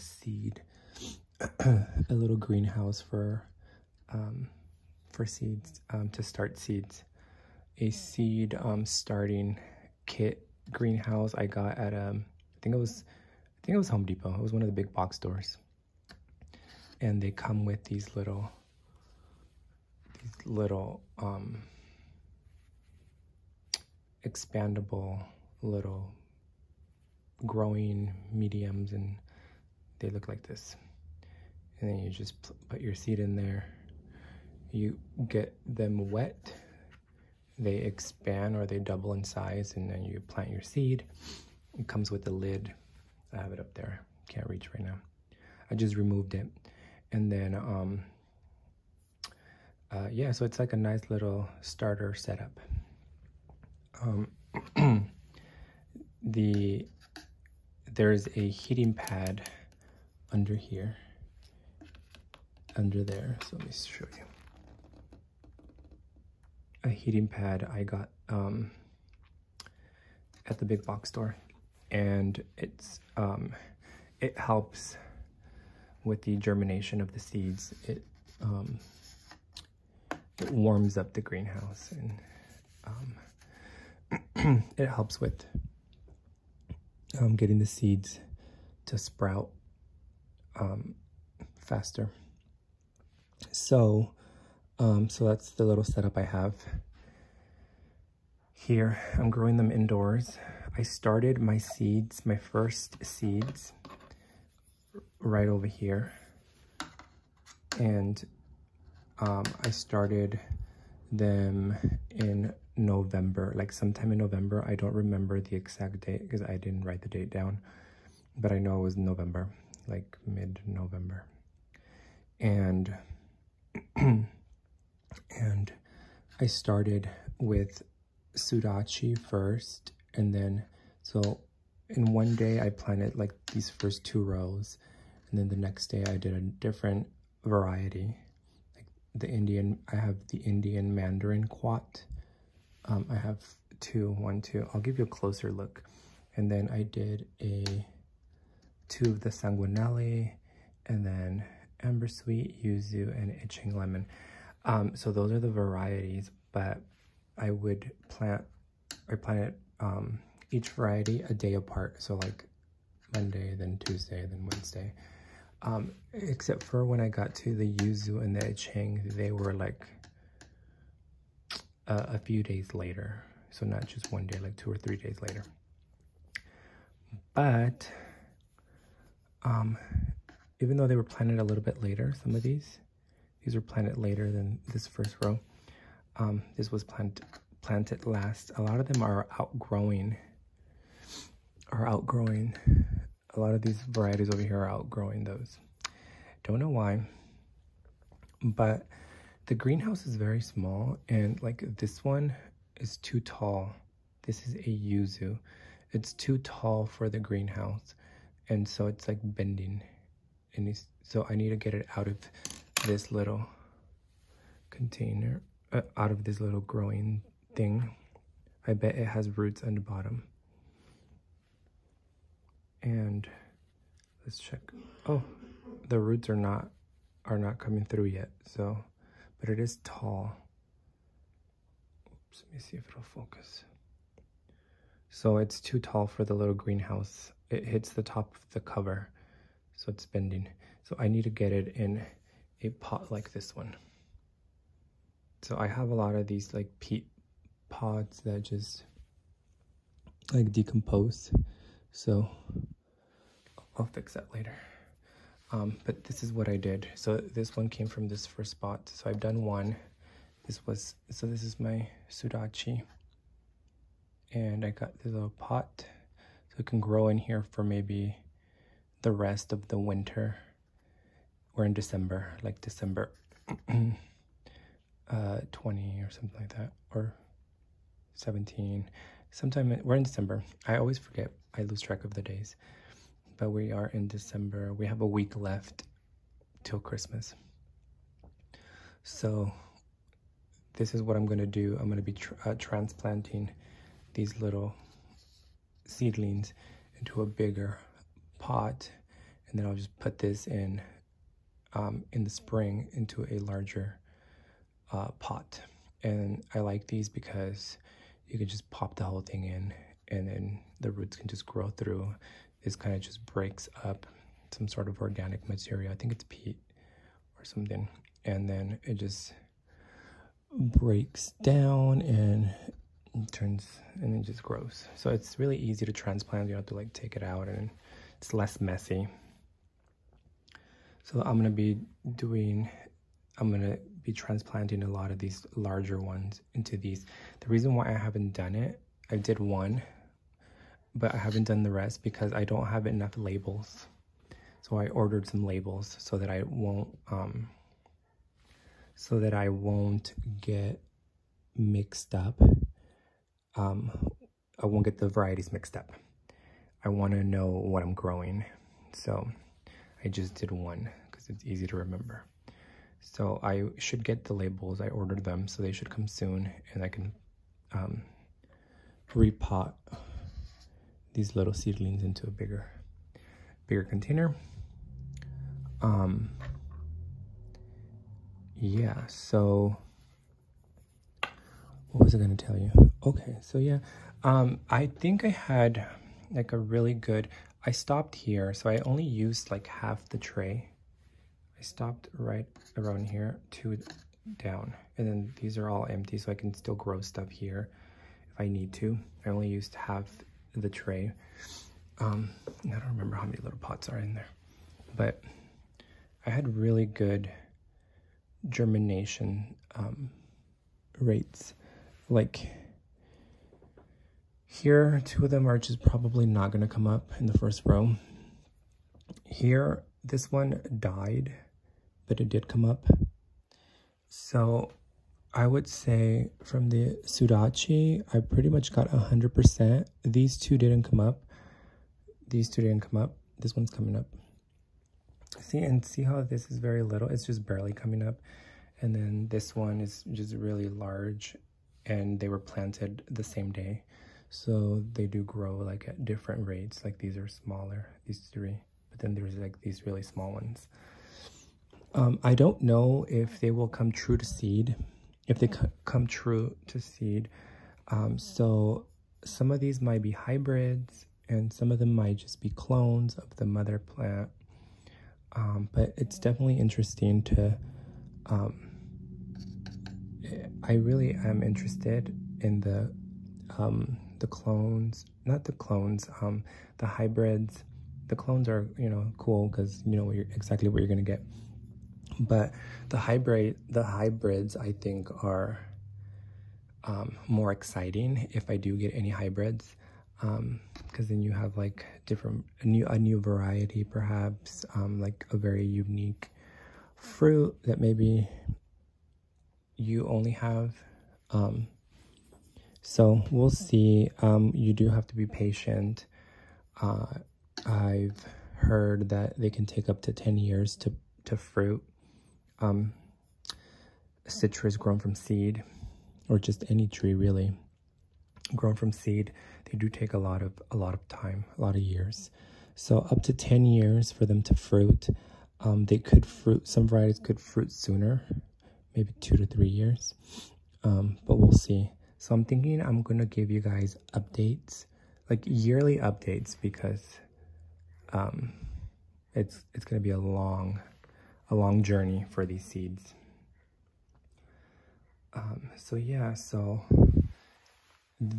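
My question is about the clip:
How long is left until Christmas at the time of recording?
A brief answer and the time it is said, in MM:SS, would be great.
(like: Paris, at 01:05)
A week, at 04:45.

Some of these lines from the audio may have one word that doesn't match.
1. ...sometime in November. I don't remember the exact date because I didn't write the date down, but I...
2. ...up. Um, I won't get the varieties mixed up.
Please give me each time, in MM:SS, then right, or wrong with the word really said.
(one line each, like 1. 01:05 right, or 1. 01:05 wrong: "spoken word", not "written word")
1. 01:53 right
2. 05:52 right.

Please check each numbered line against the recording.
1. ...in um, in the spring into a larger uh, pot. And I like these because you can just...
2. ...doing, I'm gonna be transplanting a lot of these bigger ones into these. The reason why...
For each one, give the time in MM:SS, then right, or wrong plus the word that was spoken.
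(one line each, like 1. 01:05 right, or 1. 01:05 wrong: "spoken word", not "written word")
1. 05:00 right
2. 05:32 wrong: "larger", not "bigger".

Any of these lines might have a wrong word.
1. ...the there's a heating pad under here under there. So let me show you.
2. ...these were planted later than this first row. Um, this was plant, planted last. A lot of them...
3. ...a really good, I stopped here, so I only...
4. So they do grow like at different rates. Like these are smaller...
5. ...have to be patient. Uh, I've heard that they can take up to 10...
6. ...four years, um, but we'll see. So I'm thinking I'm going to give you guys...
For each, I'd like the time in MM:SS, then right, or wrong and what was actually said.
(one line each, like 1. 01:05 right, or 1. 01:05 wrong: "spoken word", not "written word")
1. 00:56 right
2. 03:03 right
3. 06:26 right
4. 07:24 right
5. 08:24 right
6. 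08:49 wrong: "three", not "four".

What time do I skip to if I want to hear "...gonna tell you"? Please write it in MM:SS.
06:22.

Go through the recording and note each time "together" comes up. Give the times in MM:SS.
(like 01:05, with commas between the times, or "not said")
not said.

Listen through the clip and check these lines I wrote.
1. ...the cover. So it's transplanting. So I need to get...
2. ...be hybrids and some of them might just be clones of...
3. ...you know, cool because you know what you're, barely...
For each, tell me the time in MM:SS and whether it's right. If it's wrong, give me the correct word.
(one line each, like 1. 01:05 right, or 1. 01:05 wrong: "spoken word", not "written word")
1. 03:58 wrong: "bending", not "transplanting"
2. 07:40 right
3. 07:58 wrong: "exactly", not "barely".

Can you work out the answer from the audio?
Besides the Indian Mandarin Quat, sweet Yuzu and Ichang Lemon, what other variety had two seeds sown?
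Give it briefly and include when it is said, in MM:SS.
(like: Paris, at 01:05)
Sanguinelli, at 02:29.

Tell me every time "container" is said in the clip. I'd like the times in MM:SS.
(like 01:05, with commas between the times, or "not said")
03:34, 06:13.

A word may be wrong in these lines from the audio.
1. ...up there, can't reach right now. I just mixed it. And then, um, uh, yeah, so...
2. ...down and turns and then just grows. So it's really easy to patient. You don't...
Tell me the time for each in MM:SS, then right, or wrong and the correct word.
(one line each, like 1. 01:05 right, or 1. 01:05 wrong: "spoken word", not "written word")
1. 00:43 wrong: "removed", not "mixed"
2. 05:21 wrong: "transplant", not "patient".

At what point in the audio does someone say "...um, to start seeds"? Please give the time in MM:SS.
00:05.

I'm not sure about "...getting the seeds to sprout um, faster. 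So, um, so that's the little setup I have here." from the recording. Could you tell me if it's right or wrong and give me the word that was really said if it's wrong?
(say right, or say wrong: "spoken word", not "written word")
right.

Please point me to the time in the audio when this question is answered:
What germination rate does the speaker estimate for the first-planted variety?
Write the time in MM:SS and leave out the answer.
07:08.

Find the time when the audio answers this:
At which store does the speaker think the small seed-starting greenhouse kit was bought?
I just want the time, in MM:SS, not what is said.
00:13.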